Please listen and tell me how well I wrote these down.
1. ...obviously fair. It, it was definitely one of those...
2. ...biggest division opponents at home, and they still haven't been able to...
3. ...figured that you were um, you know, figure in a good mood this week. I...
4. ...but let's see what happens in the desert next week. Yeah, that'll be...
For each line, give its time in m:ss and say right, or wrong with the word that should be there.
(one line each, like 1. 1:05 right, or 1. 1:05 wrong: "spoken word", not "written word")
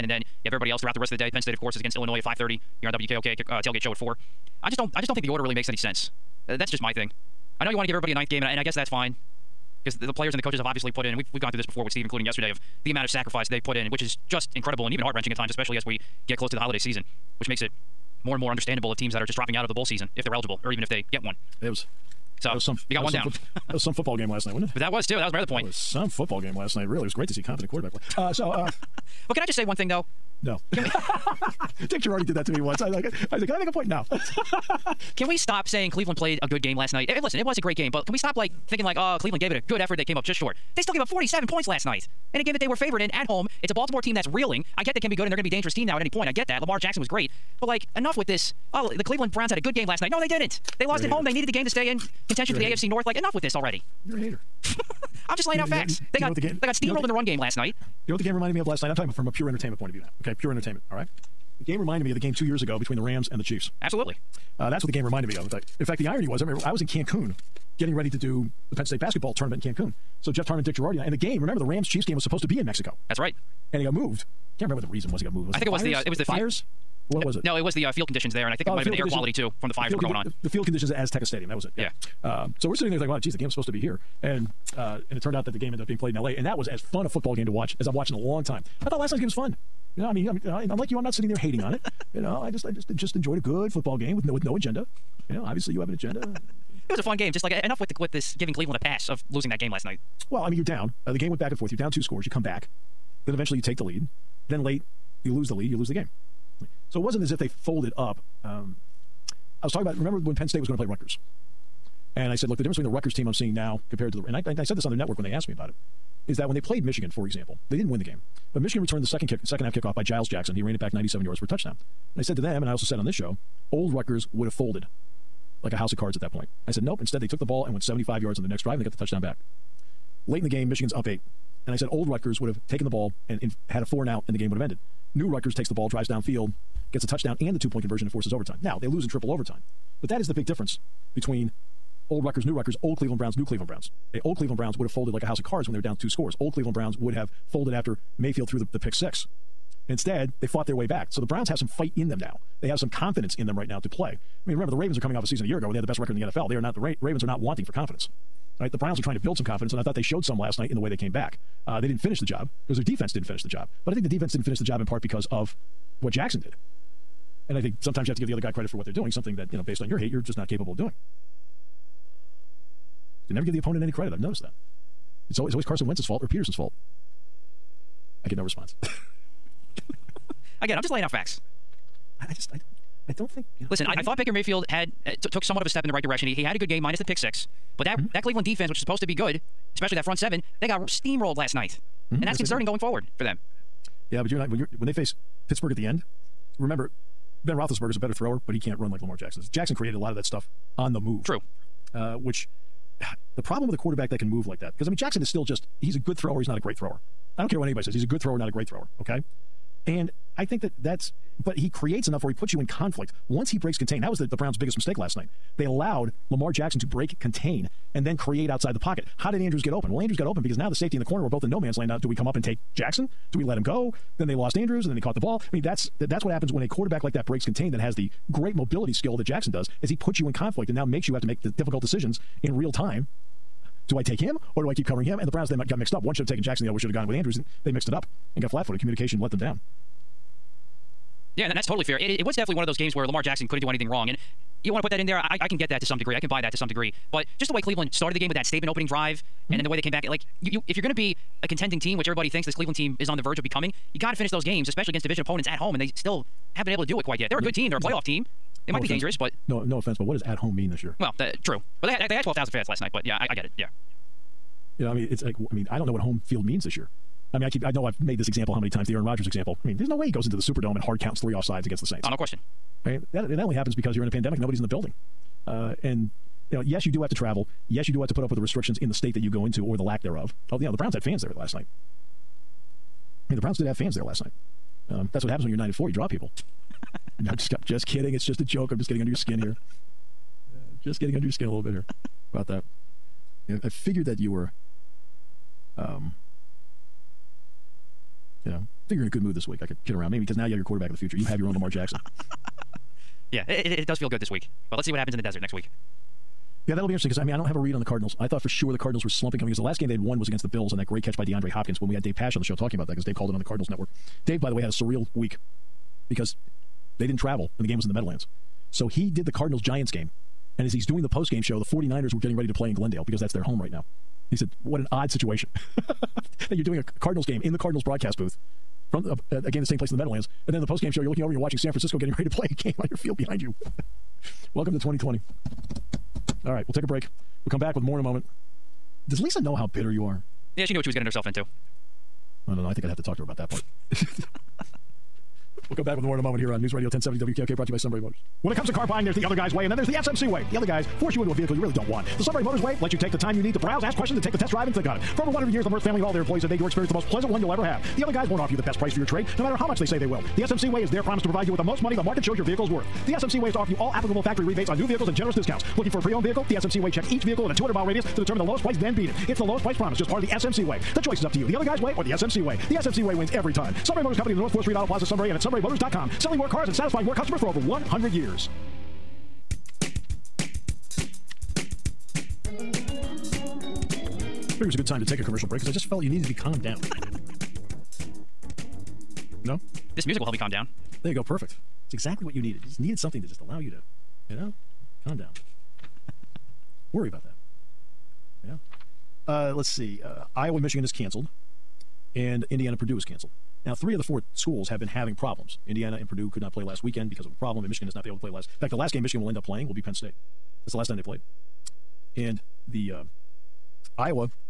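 1. 4:01 wrong: "totally", not "obviously"
2. 4:14 wrong: "against", not "biggest"
3. 4:53 right
4. 5:04 right.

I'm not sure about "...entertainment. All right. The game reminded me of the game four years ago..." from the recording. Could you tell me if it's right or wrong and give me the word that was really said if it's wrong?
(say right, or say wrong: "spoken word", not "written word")
wrong: "two", not "four".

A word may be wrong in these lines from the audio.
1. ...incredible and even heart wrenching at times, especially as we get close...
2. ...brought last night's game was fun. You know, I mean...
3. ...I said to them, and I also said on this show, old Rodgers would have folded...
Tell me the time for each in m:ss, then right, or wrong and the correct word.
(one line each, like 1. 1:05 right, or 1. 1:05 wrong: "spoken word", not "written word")
1. 0:14 right
2. 1:28 wrong: "thought", not "brought"
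3. 2:02 wrong: "Rutgers", not "Rodgers".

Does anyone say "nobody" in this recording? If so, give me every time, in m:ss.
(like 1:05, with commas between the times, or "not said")
4:34.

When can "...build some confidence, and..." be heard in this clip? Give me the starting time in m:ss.
2:39.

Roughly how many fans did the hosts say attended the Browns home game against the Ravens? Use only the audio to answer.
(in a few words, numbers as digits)
12,000.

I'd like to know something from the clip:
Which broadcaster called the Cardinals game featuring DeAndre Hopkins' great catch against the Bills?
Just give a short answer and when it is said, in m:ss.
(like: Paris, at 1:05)
Dave Pasch, at 5:12.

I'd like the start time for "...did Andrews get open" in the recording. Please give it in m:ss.
3:39.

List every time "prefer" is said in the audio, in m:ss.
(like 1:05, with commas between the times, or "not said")
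not said.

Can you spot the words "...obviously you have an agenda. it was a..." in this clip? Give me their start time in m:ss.
1:35.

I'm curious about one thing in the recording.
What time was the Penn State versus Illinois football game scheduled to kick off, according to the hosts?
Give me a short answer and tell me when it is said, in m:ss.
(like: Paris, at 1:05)
5:30, at 0:02.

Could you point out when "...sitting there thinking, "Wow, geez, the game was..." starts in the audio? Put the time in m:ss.
1:22.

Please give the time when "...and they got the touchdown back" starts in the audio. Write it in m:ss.
2:08.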